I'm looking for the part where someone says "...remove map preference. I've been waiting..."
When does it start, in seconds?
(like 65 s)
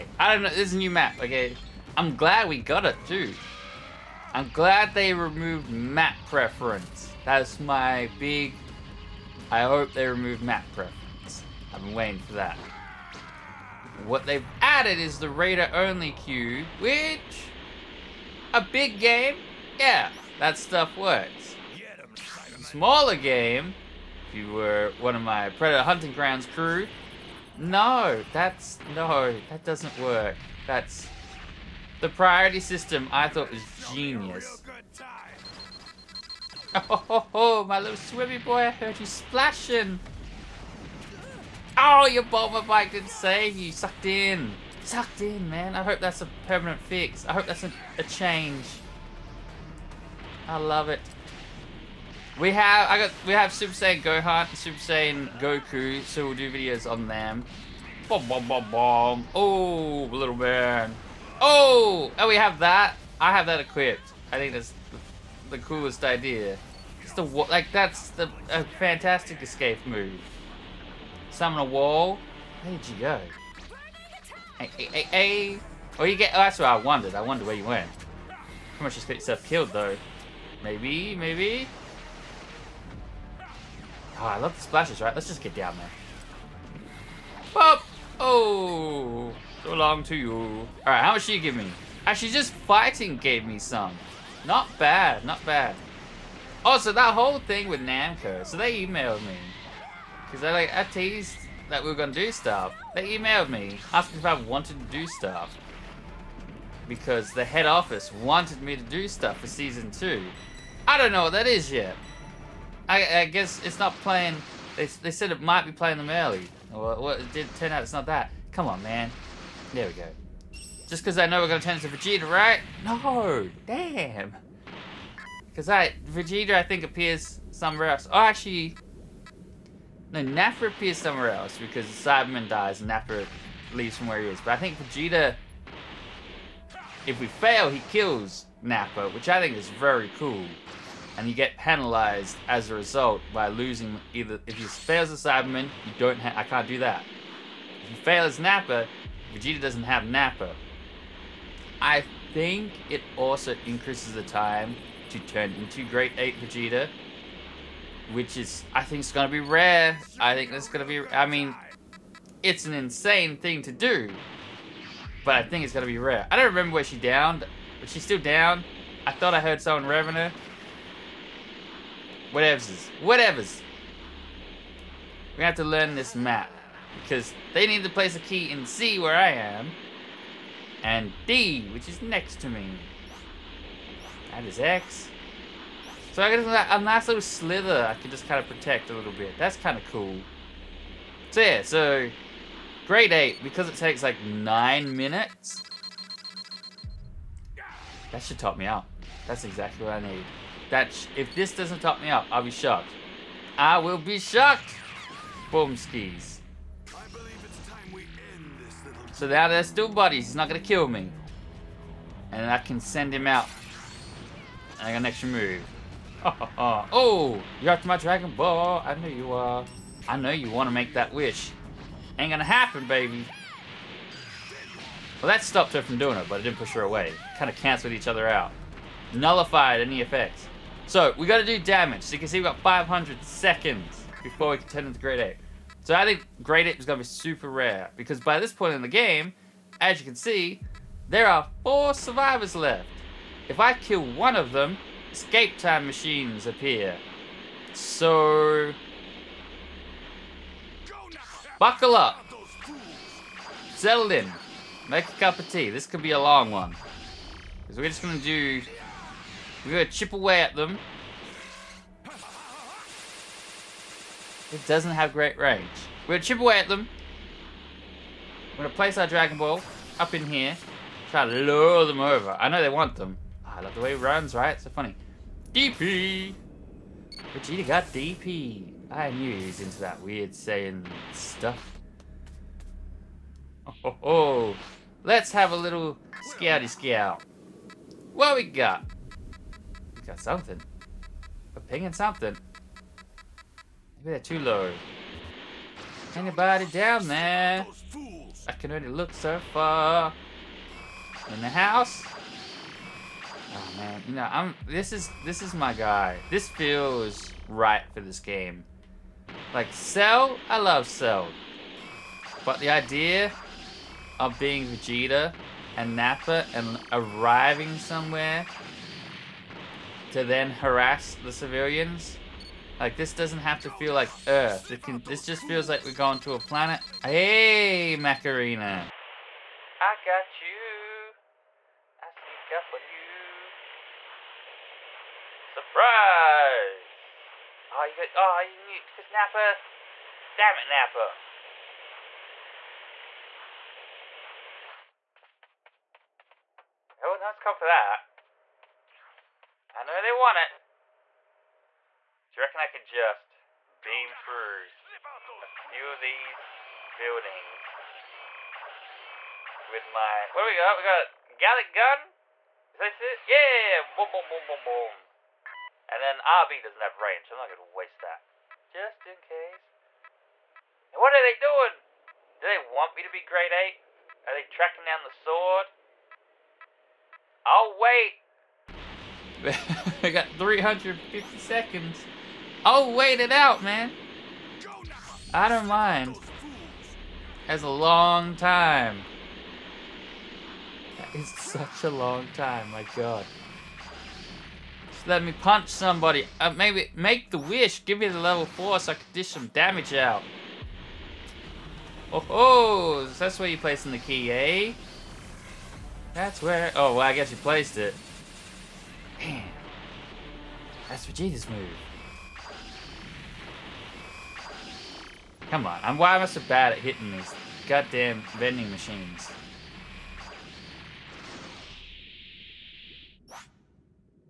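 10 s.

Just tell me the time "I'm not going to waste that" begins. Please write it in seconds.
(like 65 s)
367 s.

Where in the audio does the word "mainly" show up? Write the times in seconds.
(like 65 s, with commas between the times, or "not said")
not said.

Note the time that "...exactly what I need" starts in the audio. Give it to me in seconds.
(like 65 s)
199 s.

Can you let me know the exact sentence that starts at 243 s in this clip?
If I kill one of them, escape time machines appear.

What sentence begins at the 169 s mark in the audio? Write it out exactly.
I thought I heard someone revving her.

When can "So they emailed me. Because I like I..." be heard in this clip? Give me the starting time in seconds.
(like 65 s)
98 s.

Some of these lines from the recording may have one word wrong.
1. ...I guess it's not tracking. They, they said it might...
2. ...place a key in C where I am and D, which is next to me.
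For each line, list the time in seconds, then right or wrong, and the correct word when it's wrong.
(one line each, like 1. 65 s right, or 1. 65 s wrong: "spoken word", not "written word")
1. 113 s wrong: "playing", not "tracking"
2. 177 s right.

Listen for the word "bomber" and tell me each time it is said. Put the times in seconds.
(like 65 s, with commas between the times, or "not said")
42 s.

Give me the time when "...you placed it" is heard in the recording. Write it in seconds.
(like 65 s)
407 s.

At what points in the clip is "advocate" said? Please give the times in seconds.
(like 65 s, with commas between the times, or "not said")
not said.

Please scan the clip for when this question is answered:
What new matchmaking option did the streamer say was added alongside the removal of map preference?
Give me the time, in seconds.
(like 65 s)
15 s.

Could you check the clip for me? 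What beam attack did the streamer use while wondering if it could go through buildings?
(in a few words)
Galick Gun.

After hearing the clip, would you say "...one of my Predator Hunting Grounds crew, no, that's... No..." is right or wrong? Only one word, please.
right.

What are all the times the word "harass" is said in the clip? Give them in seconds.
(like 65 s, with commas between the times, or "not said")
320 s.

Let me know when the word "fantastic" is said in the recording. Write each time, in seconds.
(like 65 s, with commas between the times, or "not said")
68 s.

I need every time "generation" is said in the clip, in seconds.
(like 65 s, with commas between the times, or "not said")
not said.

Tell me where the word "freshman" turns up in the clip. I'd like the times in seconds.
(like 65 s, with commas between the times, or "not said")
not said.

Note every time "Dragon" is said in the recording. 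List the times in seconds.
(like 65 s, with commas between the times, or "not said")
217 s, 269 s.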